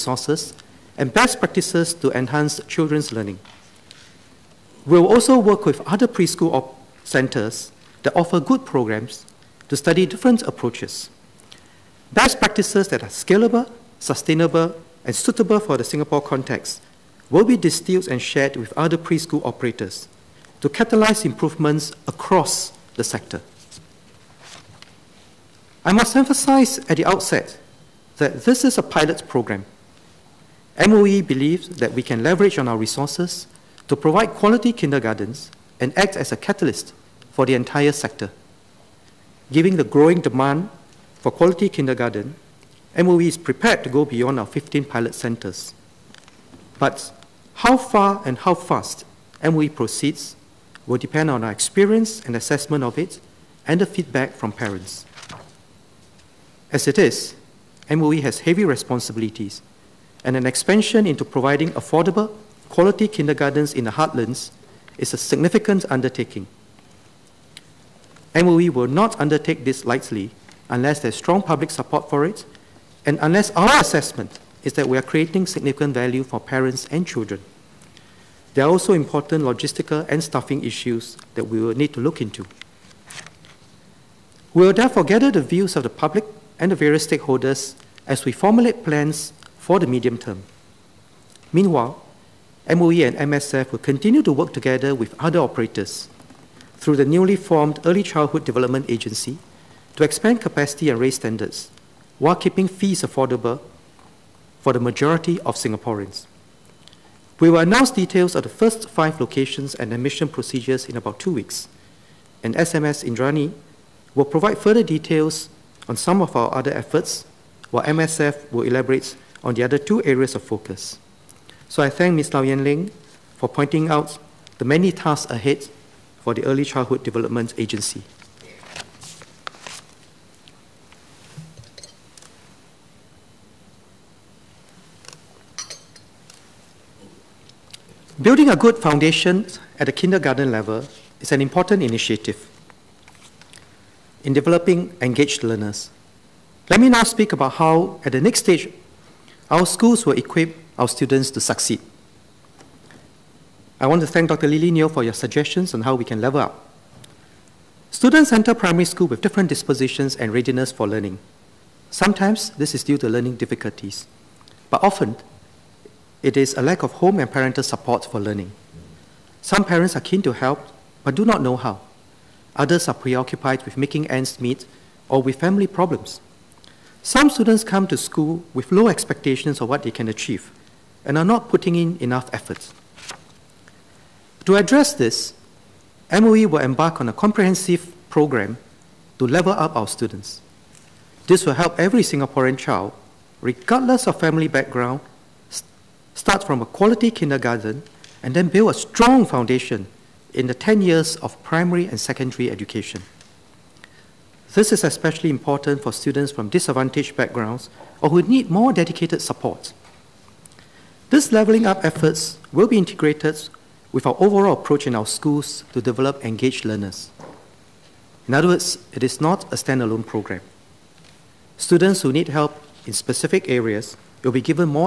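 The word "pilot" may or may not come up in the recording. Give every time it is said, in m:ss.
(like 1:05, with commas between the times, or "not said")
0:28, 0:44.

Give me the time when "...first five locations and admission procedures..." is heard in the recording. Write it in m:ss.
1:48.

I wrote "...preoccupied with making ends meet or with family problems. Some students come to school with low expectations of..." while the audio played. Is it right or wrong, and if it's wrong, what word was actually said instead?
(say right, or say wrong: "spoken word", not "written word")
right.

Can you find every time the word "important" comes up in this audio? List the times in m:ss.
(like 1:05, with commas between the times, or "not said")
1:18, 2:21, 3:25.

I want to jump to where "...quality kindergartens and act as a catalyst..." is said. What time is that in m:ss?
0:34.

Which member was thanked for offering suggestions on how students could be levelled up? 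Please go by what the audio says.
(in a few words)
Dr. Lily Neo.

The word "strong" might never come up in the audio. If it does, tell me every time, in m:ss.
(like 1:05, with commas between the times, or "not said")
1:11, 3:18.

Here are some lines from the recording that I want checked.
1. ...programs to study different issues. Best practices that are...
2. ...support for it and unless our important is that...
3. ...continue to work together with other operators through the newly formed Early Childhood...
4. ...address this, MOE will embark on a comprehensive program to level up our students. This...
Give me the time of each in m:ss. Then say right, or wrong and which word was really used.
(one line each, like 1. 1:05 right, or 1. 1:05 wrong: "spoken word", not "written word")
1. 0:08 wrong: "approaches", not "issues"
2. 1:11 wrong: "assessment", not "important"
3. 1:33 right
4. 3:04 right.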